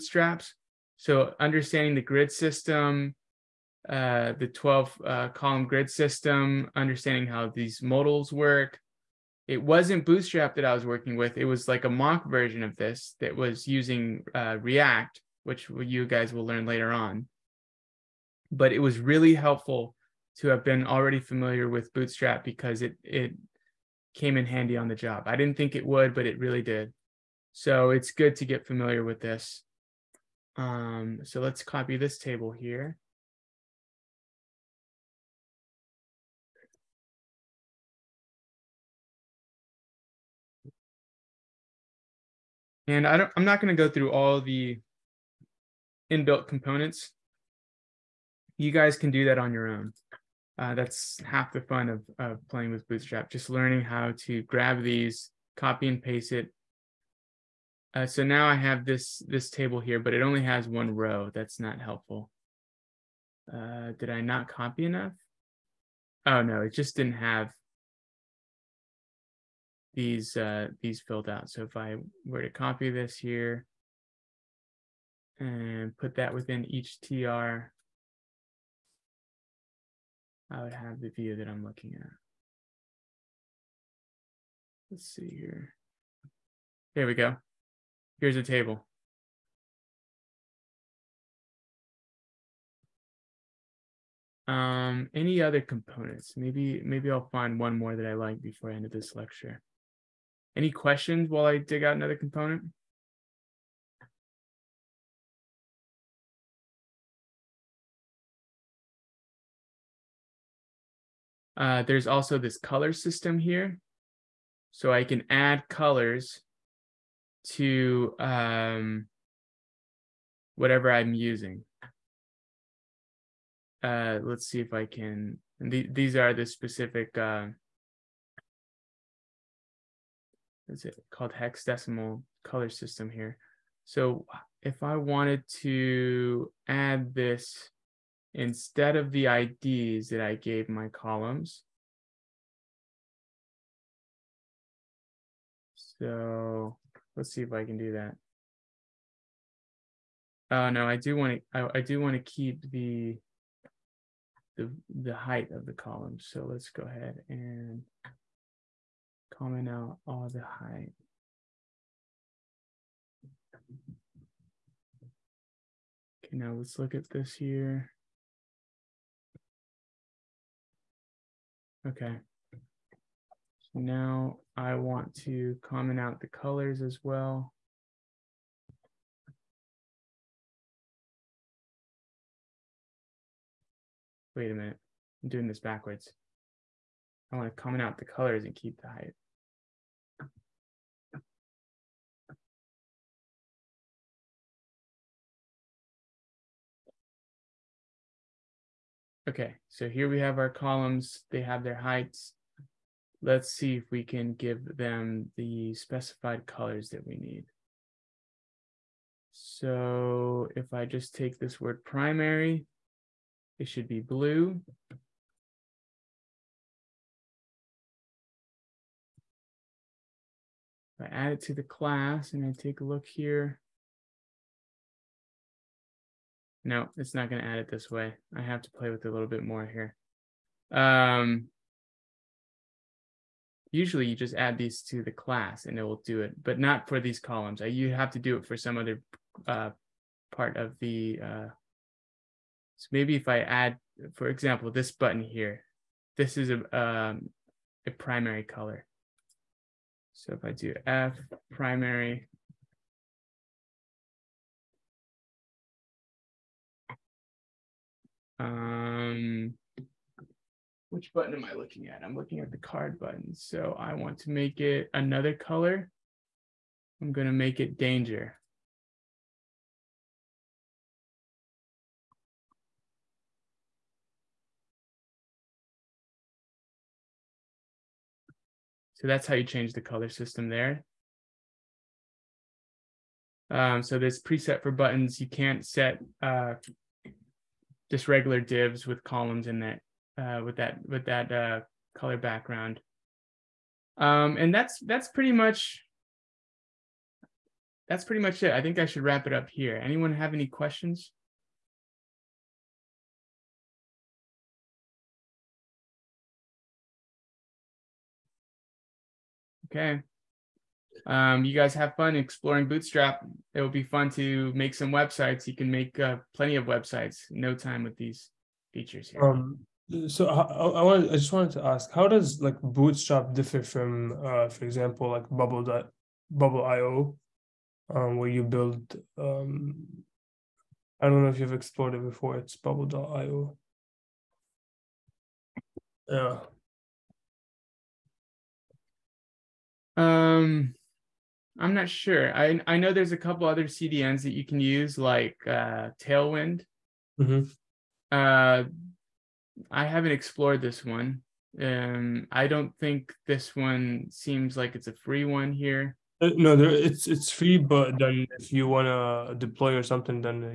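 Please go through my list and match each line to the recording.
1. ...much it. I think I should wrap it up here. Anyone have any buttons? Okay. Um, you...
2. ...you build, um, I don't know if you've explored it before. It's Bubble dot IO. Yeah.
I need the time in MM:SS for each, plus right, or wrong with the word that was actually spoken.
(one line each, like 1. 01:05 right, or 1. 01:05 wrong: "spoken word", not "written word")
1. 04:58 wrong: "questions", not "buttons"
2. 05:28 right.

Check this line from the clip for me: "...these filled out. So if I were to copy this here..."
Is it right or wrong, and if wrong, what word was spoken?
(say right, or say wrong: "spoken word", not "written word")
right.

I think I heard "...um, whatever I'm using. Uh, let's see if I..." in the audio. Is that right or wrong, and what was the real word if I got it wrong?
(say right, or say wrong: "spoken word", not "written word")
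right.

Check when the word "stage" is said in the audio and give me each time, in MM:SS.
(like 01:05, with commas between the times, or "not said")
not said.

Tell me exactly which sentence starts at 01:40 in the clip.
Any questions while I dig out another component?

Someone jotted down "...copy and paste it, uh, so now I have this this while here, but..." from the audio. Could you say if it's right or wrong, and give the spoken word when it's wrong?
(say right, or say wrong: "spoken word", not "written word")
wrong: "table", not "while".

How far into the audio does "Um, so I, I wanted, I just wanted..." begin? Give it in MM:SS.
05:19.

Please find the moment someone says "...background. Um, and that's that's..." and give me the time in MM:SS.
04:52.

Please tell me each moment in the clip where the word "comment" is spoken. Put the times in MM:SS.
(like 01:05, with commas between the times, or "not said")
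02:39, 02:55, 03:07.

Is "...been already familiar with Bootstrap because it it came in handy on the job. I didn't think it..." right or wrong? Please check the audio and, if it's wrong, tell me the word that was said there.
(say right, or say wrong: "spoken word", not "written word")
right.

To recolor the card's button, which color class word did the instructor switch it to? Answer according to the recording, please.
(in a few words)
danger.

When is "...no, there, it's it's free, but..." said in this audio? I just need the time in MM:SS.
05:56.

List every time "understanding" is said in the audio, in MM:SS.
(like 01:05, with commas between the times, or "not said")
00:01, 00:06.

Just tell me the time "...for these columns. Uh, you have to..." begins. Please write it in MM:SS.
03:56.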